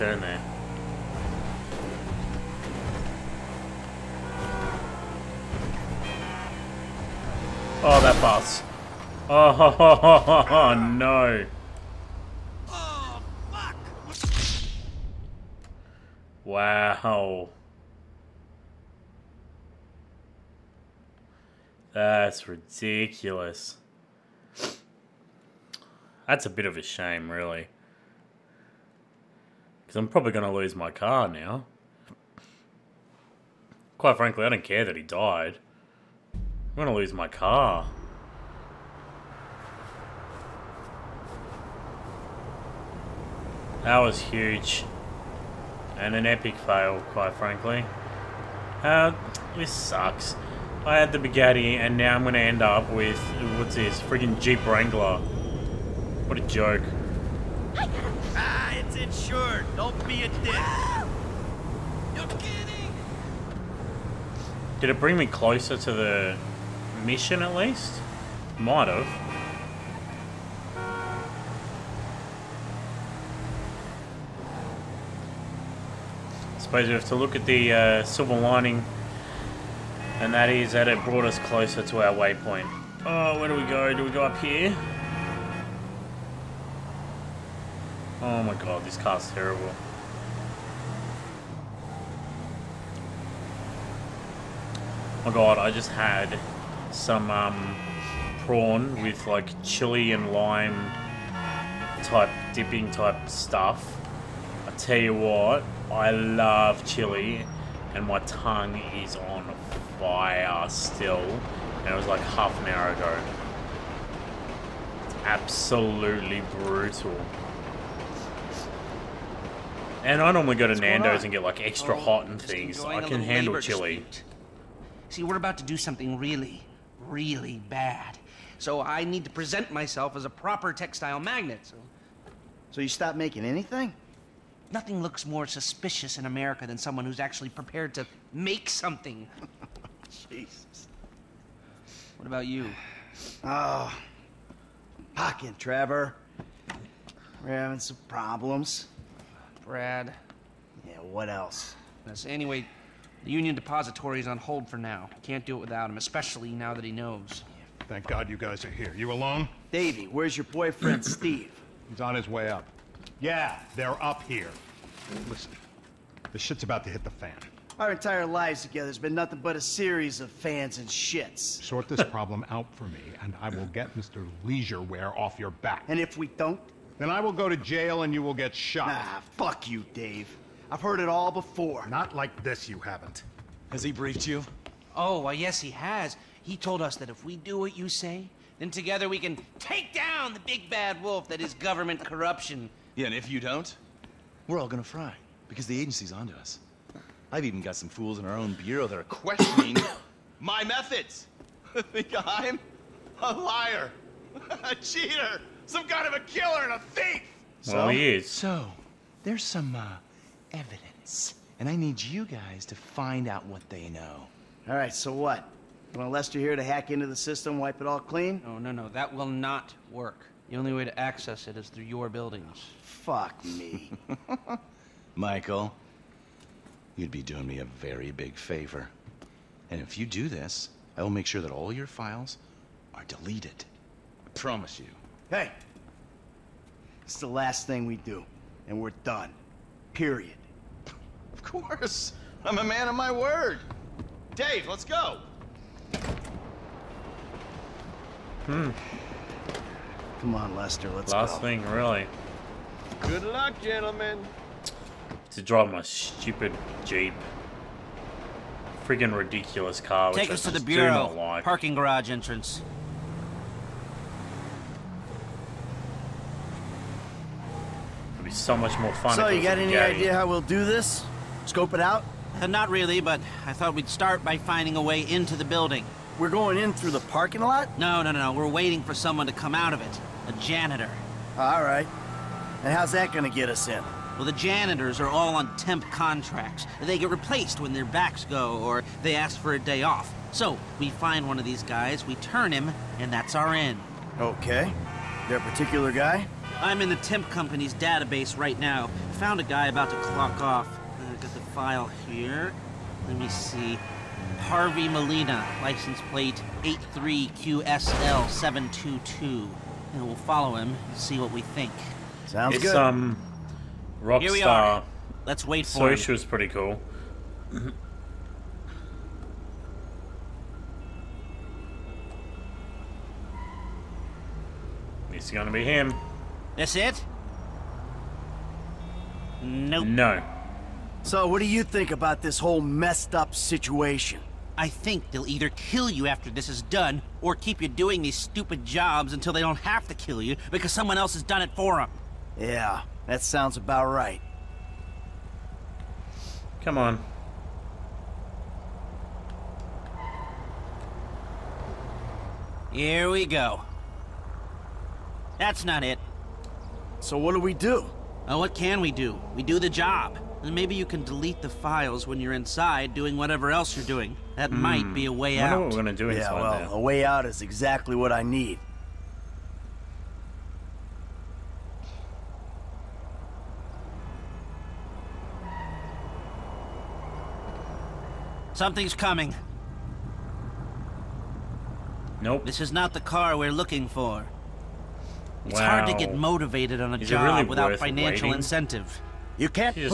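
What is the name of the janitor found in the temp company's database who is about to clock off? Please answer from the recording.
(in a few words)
Harvey Molina.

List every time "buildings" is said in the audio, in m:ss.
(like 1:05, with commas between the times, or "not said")
3:42, 4:35.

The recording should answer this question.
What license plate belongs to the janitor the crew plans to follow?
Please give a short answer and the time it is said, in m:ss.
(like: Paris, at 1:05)
83QSL722, at 5:06.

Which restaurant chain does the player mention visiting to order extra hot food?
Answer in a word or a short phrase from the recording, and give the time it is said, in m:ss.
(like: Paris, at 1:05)
Nando's, at 2:00.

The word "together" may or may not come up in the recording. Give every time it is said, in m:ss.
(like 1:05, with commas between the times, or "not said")
2:48, 3:08.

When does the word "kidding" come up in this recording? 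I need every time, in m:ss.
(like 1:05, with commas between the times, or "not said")
1:02.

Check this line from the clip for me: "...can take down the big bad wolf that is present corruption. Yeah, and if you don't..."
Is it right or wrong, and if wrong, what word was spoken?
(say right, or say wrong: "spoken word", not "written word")
wrong: "government", not "present".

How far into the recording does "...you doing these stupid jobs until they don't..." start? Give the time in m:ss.
5:37.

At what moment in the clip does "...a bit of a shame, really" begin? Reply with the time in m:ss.
0:26.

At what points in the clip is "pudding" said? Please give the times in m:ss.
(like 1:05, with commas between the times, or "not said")
not said.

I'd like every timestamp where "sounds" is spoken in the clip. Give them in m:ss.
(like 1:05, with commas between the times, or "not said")
5:12, 5:43.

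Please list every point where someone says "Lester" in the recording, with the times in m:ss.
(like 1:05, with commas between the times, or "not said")
3:36, 4:10.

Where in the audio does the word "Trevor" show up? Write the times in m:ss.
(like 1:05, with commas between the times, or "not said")
2:25.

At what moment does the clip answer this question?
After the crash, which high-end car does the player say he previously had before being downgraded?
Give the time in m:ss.
0:51.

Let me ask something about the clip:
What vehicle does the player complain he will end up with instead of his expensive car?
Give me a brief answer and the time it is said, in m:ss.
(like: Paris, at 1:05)
Jeep Wrangler, at 0:54.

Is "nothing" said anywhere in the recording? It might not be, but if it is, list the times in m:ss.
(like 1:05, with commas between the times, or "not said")
2:14, 2:49.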